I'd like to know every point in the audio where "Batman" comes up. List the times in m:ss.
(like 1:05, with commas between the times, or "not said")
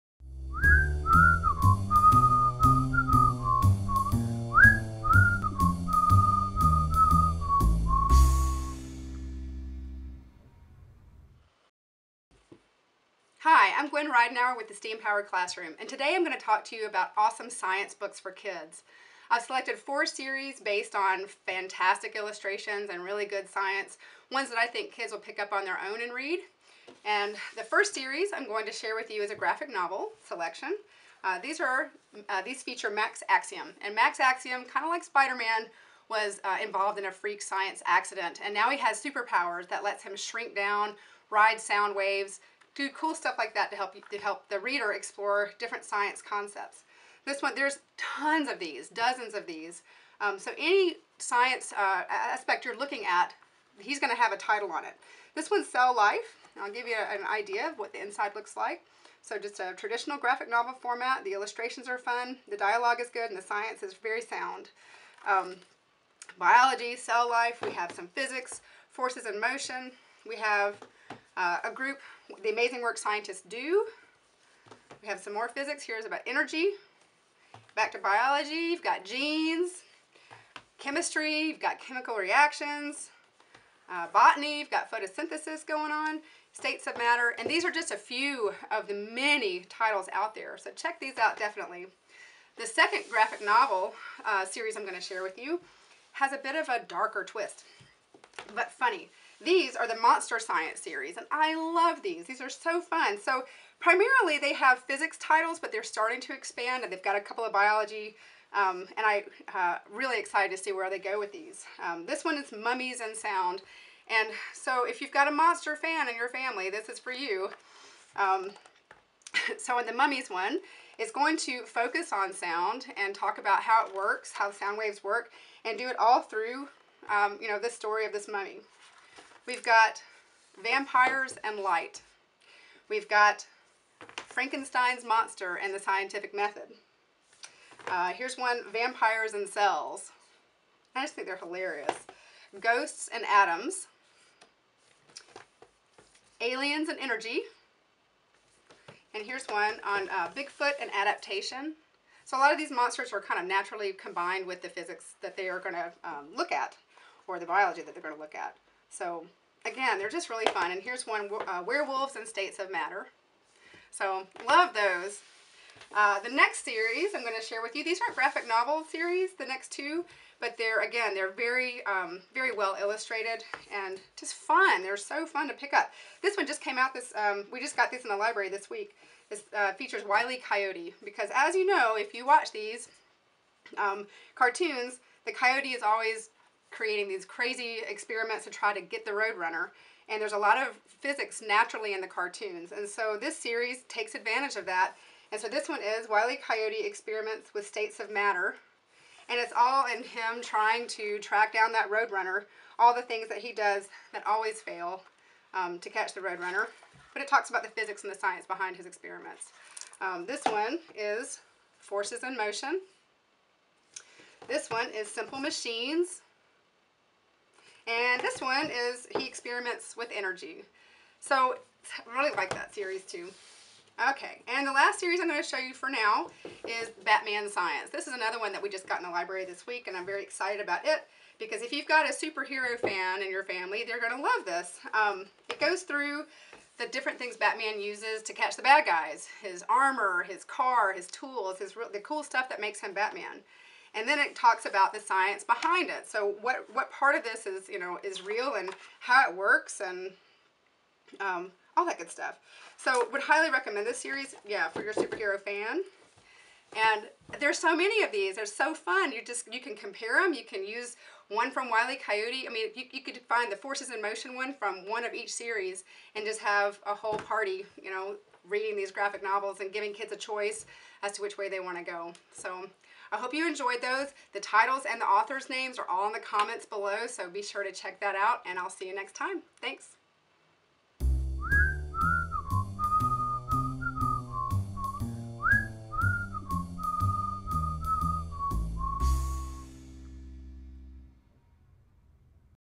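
3:47, 3:57, 4:02.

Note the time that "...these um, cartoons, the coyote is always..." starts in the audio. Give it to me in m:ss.
3:02.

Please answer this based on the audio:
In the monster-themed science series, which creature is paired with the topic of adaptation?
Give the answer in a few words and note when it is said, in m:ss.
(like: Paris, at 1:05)
Bigfoot, at 2:30.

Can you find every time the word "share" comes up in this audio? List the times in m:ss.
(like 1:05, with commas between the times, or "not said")
0:28, 1:35, 2:47.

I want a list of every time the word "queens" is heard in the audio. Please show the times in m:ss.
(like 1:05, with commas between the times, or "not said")
not said.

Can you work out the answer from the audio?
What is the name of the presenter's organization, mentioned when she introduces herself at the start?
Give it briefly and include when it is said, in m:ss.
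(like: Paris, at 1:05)
STEAM Powered Classroom, at 0:14.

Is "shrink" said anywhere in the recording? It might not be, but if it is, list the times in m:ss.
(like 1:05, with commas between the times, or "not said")
0:40.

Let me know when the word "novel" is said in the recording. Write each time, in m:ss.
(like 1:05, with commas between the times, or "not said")
0:29, 1:00, 1:33, 2:48, 4:29.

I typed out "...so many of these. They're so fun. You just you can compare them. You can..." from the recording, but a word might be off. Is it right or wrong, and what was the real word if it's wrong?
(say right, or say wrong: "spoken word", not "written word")
right.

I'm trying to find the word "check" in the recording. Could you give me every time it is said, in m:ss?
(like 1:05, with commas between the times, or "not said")
1:30, 4:37.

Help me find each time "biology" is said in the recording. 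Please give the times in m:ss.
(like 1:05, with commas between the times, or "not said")
1:06, 1:17, 1:47, 2:37.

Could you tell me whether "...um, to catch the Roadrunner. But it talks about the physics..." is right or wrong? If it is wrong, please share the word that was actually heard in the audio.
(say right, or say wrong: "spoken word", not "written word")
right.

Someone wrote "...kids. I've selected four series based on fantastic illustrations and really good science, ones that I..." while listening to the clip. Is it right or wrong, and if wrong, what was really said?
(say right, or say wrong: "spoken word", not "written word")
right.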